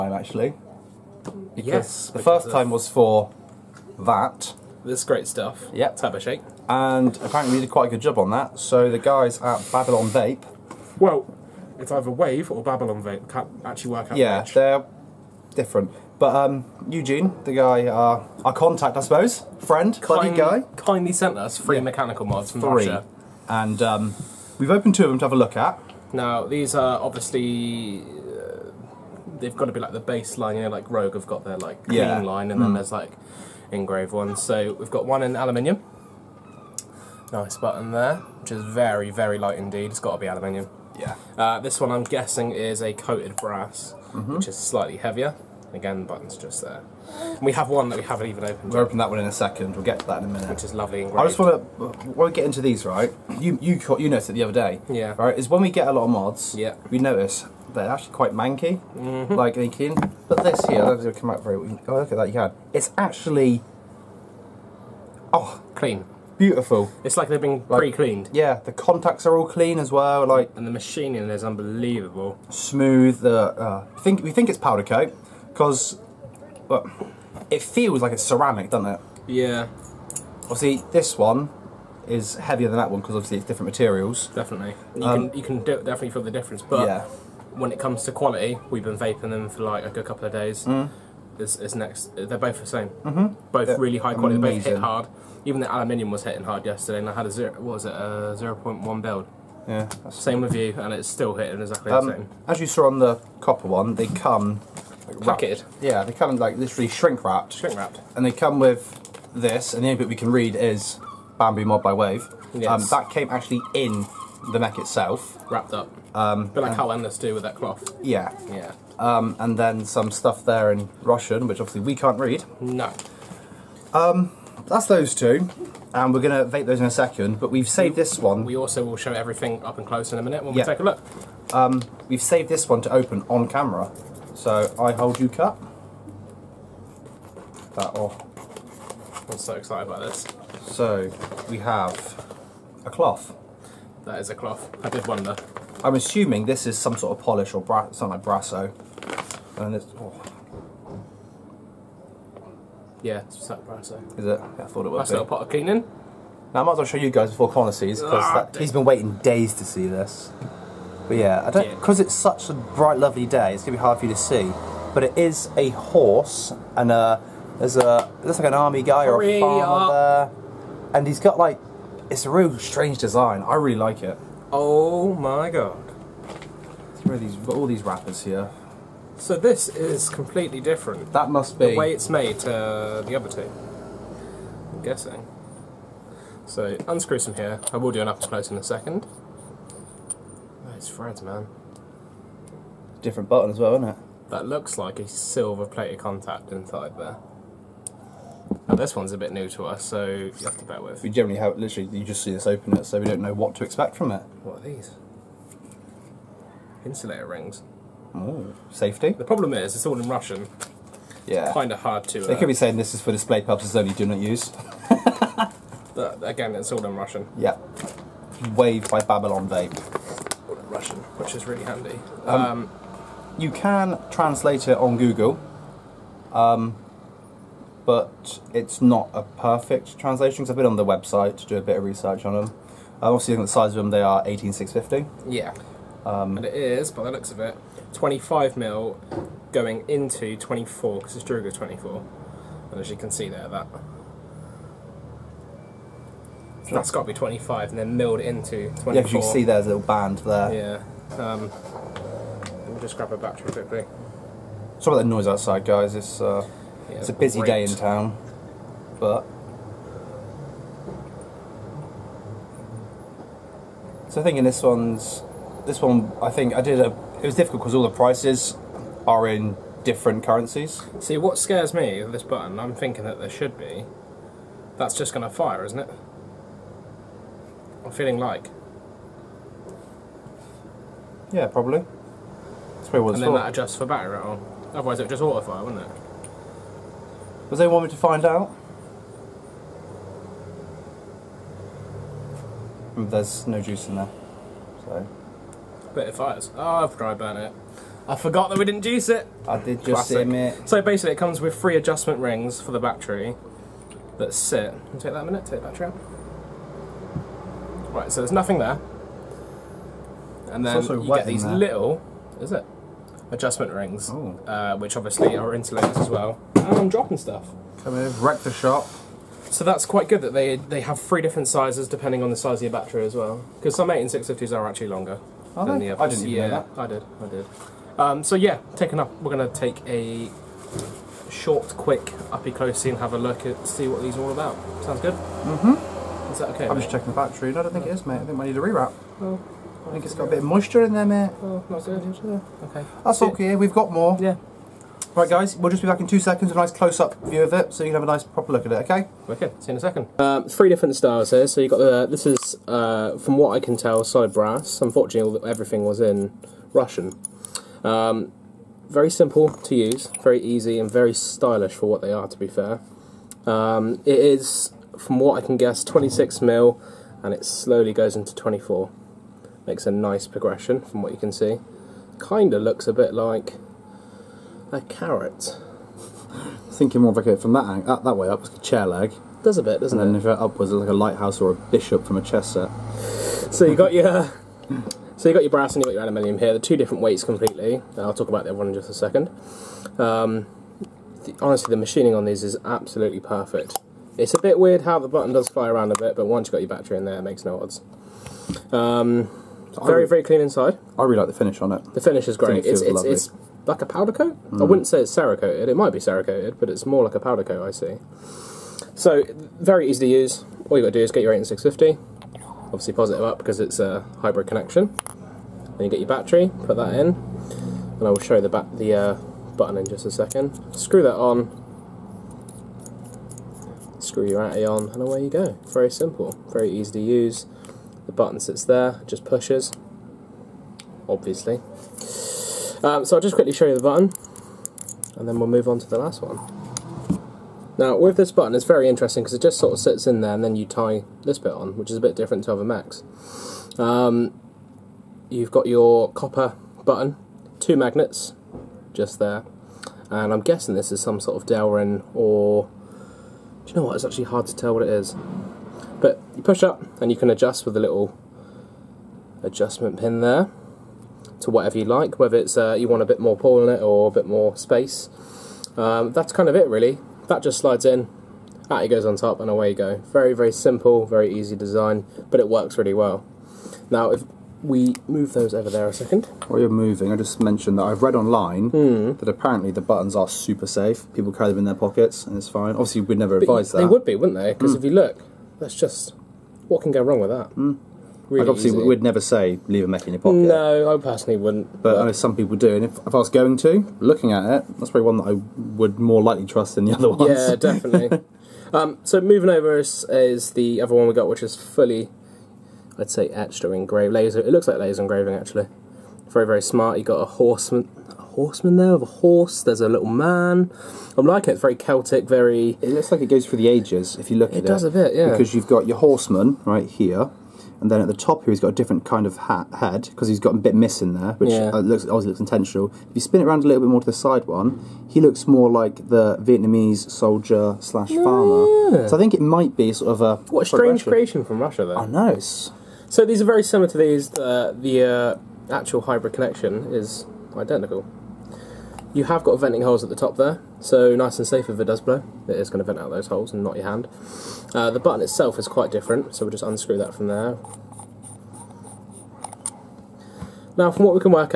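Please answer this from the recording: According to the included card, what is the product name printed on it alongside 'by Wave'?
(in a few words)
Bamboo Mod.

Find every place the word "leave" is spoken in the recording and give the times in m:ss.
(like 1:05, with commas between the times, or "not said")
8:09.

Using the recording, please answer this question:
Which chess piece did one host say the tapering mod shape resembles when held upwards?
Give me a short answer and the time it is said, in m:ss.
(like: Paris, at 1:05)
Bishop, at 6:21.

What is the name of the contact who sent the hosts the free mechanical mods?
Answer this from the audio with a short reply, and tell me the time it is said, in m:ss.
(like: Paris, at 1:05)
Eugene, at 0:16.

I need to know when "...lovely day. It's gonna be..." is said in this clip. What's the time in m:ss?
2:42.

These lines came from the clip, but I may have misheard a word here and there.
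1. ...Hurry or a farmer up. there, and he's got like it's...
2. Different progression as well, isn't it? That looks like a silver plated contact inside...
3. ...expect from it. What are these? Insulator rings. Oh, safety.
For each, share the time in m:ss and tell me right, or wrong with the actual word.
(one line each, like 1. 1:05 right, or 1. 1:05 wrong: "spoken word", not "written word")
1. 2:49 right
2. 3:12 wrong: "button", not "progression"
3. 3:23 right.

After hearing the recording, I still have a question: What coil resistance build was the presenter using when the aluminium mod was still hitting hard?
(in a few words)
0.1.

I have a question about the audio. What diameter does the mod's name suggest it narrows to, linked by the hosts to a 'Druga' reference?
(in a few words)
24.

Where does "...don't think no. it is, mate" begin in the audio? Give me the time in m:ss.
5:37.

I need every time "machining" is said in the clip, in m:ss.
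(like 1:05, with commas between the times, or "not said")
1:10, 6:31.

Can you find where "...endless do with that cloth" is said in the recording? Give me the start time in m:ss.
1:56.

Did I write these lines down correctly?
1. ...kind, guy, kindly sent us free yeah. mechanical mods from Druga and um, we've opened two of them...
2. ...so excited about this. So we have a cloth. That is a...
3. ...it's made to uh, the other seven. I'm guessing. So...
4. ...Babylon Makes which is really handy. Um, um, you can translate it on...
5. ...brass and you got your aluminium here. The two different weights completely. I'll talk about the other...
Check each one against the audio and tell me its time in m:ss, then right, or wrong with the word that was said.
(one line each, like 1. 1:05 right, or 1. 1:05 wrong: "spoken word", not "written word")
1. 0:20 wrong: "Russia", not "Druga"
2. 2:19 right
3. 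3:01 wrong: "two", not "seven"
4. 3:38 wrong: "Vape", not "Makes"
5. 6:25 right.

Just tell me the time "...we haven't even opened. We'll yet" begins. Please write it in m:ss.
0:47.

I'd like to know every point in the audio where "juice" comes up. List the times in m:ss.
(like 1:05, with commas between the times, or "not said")
4:53, 4:58.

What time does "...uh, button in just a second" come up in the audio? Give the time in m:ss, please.
6:58.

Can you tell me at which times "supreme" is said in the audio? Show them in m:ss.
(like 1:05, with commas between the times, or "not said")
not said.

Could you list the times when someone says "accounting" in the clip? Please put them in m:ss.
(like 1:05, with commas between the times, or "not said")
not said.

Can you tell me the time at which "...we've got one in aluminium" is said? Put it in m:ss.
0:34.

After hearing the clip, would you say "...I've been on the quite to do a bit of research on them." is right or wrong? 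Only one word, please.
wrong.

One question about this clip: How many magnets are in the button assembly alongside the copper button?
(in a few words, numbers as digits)
2.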